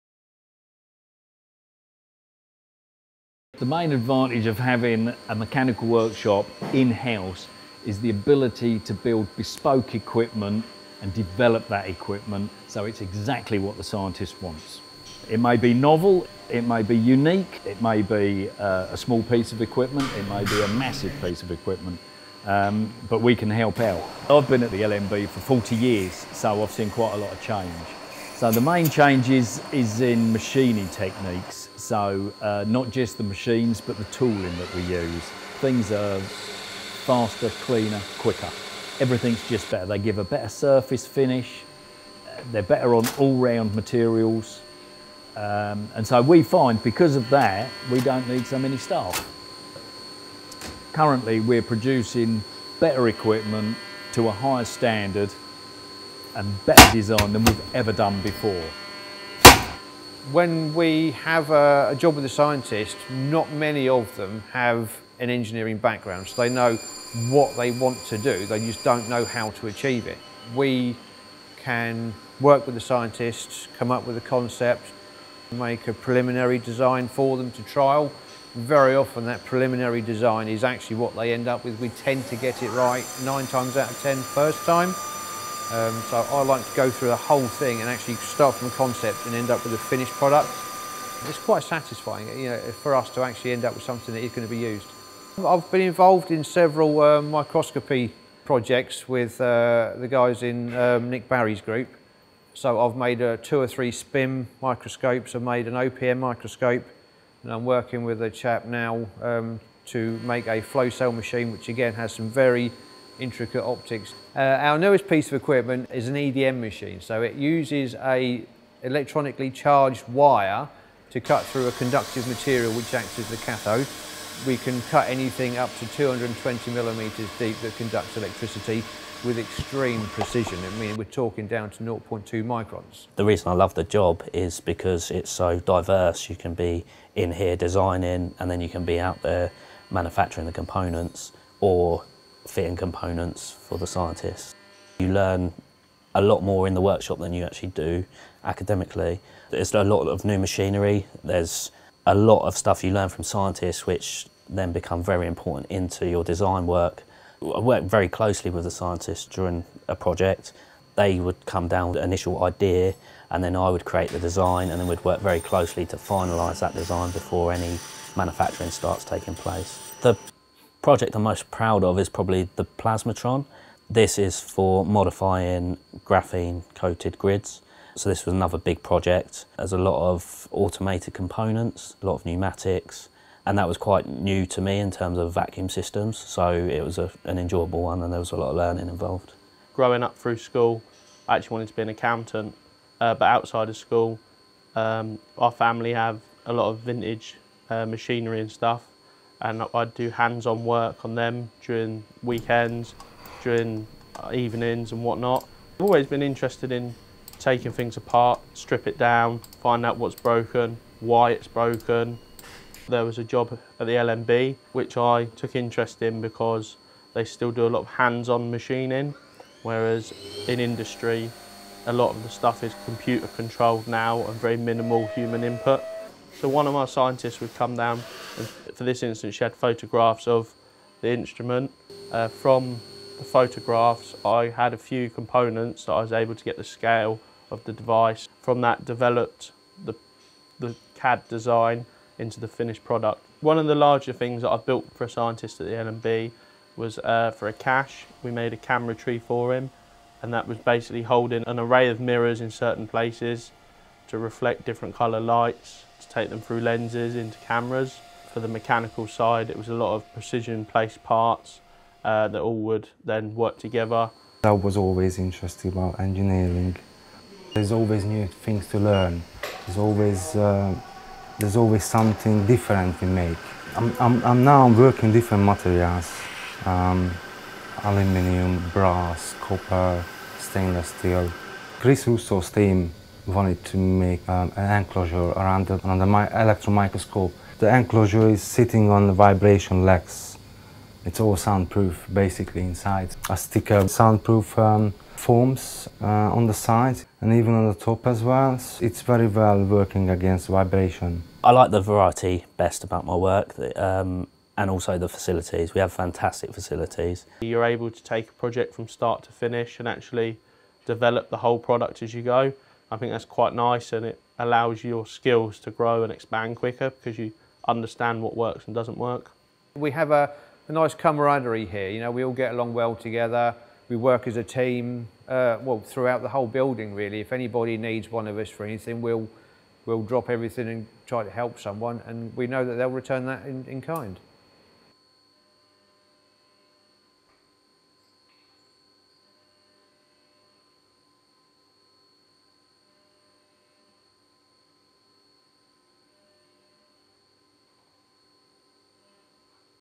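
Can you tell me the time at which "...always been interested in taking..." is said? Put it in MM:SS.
03:25.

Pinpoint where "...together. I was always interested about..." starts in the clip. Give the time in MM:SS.
04:23.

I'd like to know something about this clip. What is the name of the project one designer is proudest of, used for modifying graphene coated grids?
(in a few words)
Plasmatron.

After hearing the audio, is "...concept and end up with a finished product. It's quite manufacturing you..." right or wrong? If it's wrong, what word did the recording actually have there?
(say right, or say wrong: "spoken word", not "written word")
wrong: "satisfying", not "manufacturing".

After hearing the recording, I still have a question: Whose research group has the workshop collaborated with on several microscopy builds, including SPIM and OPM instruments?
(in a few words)
Nick Barry.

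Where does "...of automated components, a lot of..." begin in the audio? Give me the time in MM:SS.
03:00.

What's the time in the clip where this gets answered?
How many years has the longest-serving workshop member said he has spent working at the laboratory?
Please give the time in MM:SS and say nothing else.
00:25.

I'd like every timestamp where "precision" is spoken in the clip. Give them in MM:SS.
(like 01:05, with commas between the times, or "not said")
02:10, 04:20.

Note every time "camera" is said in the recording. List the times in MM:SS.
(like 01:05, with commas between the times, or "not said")
04:08, 04:17.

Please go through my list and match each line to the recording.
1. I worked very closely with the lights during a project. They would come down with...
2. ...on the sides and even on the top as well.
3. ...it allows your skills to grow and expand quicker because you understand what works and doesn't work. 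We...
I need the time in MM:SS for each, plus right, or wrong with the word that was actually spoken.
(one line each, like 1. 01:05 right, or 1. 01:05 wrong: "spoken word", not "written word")
1. 02:37 wrong: "scientists", not "lights"
2. 04:56 right
3. 05:14 right.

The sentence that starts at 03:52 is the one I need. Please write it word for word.
Uh, from the photographs I had a few components that I was able to get the scale of the device.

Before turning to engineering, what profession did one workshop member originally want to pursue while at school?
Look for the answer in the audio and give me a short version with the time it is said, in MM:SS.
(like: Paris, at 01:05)
Accountant, at 03:11.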